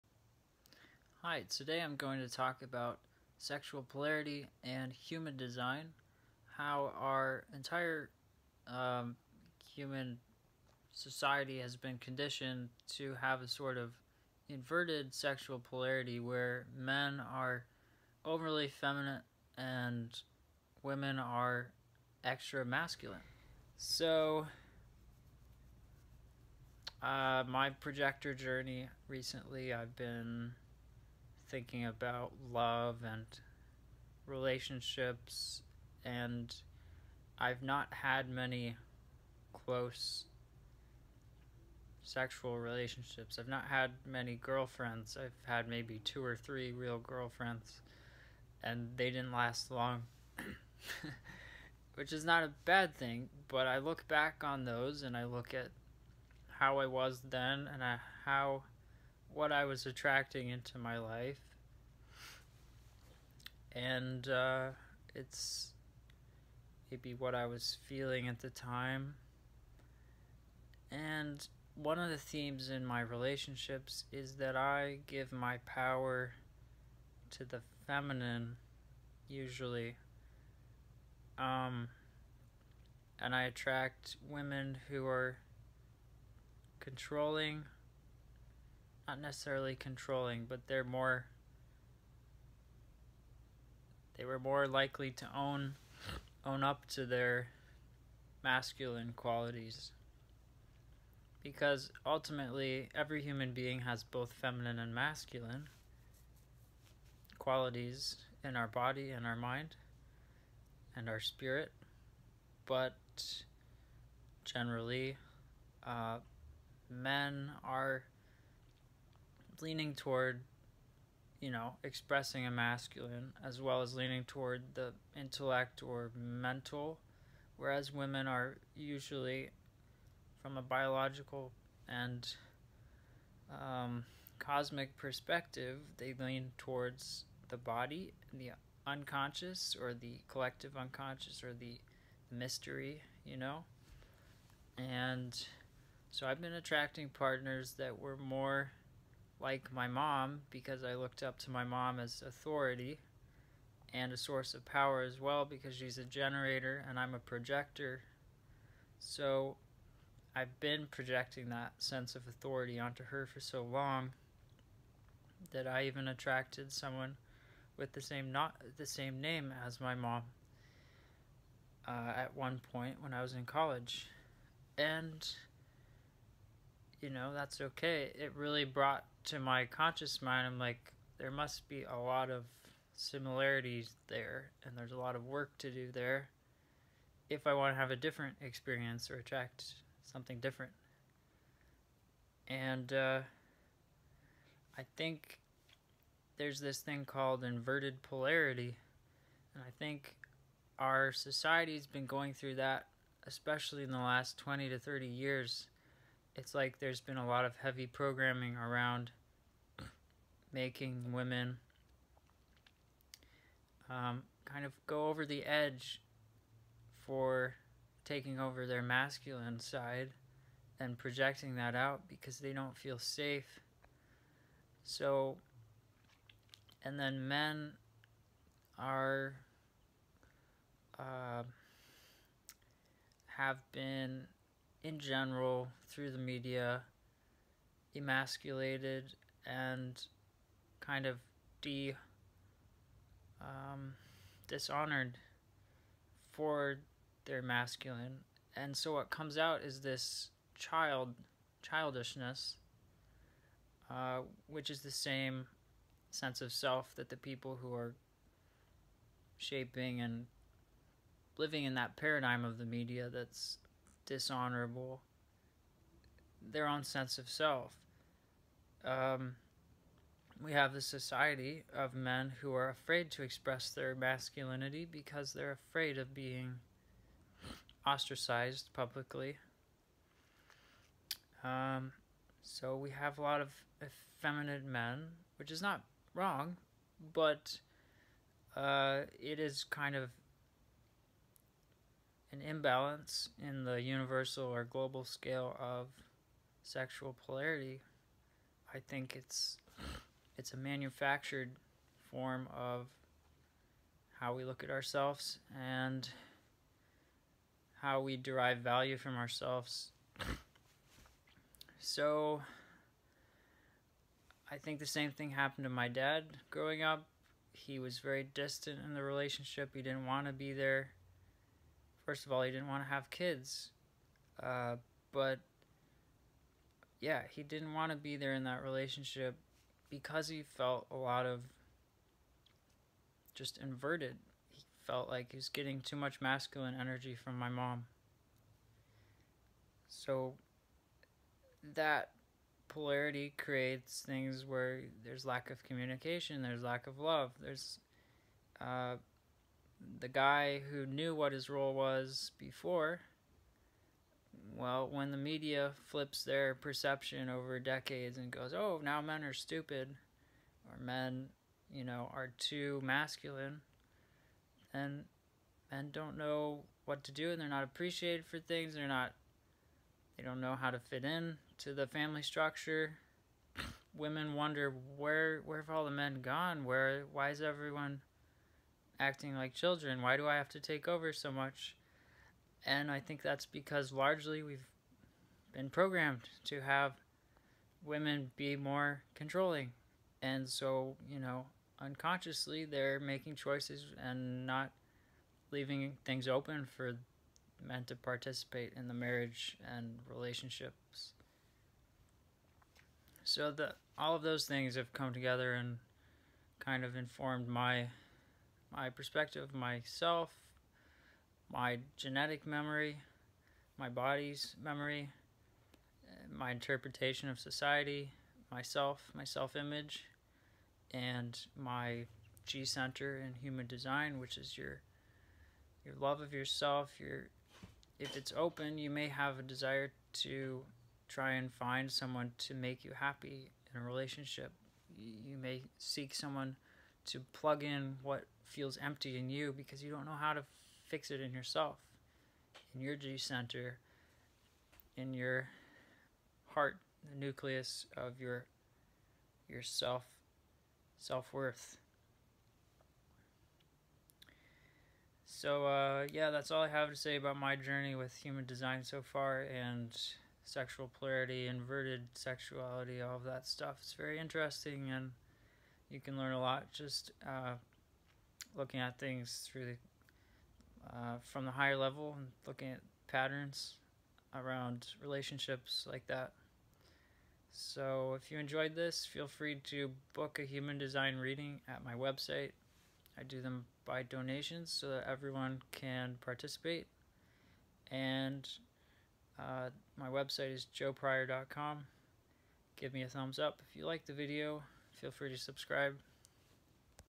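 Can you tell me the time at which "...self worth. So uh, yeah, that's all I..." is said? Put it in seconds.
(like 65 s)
450 s.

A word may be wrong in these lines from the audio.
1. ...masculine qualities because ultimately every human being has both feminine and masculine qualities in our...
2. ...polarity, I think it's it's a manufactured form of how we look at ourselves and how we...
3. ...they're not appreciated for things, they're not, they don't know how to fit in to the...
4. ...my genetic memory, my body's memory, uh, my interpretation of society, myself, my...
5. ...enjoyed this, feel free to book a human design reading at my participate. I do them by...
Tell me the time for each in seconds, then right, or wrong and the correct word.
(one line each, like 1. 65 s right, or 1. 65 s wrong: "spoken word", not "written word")
1. 98 s right
2. 297 s right
3. 367 s right
4. 411 s right
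5. 478 s wrong: "website", not "participate".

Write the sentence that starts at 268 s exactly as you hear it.
Um, we have the society of men who are afraid to express their masculinity because they're afraid of being ostracized publicly.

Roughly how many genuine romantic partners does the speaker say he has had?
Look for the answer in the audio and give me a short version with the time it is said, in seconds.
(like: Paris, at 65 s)
2 or 3, at 45 s.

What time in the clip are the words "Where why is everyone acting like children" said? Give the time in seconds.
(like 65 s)
376 s.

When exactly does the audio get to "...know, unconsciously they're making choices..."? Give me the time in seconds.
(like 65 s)
391 s.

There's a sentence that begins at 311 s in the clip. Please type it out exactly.
So I think the same thing happened to my dad growing up.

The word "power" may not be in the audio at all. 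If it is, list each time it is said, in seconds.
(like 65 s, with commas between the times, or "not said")
75 s, 154 s.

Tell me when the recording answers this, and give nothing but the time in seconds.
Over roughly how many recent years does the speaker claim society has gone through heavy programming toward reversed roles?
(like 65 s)
204 s.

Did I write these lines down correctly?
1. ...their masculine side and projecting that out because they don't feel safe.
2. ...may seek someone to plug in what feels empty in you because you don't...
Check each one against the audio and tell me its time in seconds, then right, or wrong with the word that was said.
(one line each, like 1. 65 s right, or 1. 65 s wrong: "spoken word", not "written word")
1. 218 s right
2. 435 s right.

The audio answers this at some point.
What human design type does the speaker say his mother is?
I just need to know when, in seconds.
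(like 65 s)
156 s.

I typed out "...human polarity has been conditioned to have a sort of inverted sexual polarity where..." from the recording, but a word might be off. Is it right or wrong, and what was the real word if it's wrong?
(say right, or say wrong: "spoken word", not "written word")
wrong: "society", not "polarity".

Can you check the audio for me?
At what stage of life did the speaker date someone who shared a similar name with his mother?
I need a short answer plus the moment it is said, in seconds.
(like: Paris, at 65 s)
College, at 173 s.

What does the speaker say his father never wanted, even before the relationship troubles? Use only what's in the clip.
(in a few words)
Kids.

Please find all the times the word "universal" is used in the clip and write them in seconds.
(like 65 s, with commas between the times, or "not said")
293 s.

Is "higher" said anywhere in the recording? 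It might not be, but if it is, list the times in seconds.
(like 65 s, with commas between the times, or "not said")
471 s.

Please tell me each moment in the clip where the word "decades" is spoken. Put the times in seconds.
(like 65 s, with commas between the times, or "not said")
357 s.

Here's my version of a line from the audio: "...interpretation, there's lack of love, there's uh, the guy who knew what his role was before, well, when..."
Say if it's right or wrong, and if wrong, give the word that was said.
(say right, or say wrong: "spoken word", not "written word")
wrong: "communication", not "interpretation".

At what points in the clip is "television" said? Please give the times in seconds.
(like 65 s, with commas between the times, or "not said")
not said.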